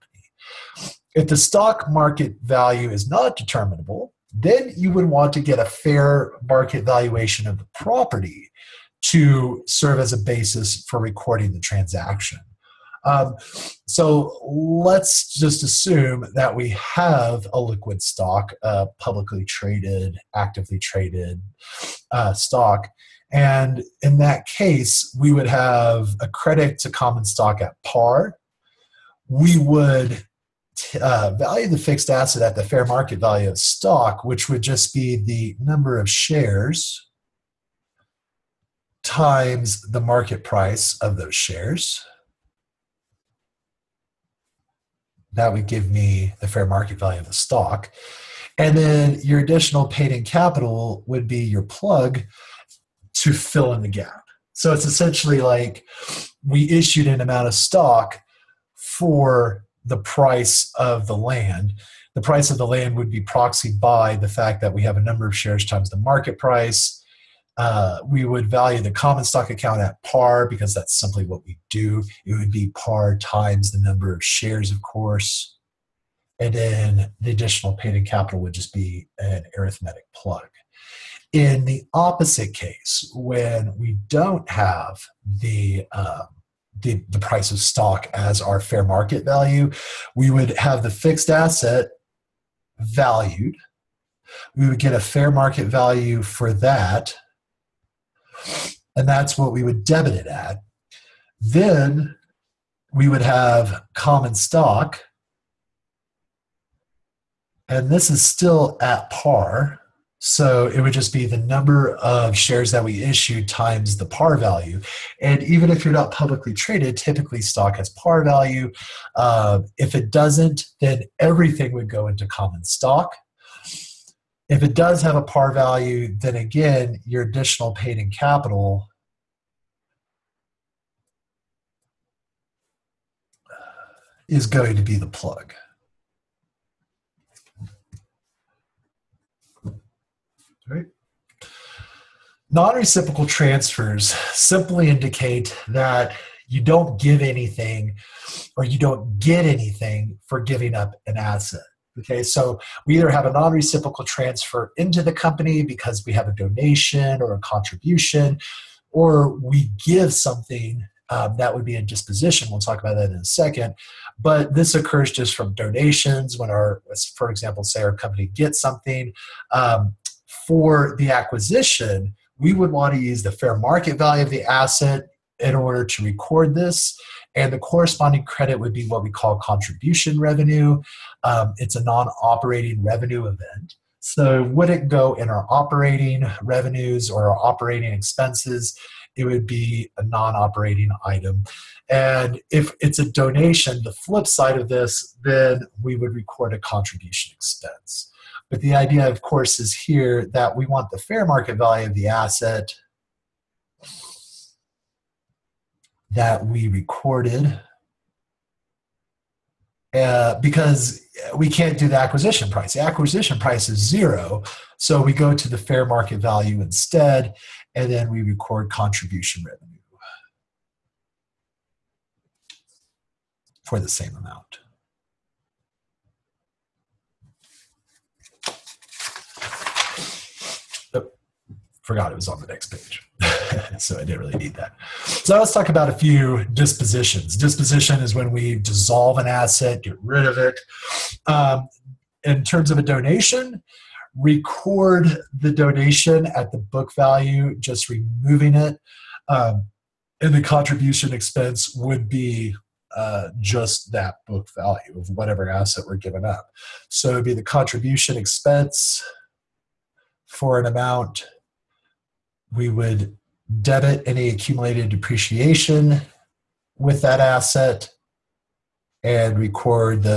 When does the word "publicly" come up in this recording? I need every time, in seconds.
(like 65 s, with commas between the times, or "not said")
18 s, 116 s.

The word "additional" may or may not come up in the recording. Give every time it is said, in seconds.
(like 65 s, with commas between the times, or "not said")
49 s, 77 s, 127 s.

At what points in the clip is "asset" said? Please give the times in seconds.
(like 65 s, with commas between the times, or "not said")
32 s, 91 s, 151 s, 174 s, 202 s, 239 s, 255 s, 267 s.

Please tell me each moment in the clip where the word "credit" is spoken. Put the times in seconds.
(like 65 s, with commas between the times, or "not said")
26 s, 178 s.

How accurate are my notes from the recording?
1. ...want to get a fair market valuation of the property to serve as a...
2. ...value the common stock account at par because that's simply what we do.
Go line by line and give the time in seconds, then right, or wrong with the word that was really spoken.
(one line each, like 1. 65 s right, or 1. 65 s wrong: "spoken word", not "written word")
1. 5 s right
2. 68 s right.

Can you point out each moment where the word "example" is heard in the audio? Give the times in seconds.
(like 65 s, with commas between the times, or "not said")
167 s.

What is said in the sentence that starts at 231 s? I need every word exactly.
forgot it was on the next page.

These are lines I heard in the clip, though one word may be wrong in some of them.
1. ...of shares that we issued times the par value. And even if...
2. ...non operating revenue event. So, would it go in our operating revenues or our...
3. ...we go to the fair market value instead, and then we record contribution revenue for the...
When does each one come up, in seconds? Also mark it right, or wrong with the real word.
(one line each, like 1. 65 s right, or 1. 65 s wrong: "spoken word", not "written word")
1. 111 s right
2. 181 s right
3. 215 s right.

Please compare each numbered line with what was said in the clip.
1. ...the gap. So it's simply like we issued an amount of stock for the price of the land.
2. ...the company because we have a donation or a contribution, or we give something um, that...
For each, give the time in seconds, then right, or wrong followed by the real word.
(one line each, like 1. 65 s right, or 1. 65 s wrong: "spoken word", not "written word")
1. 53 s wrong: "essentially", not "simply"
2. 155 s right.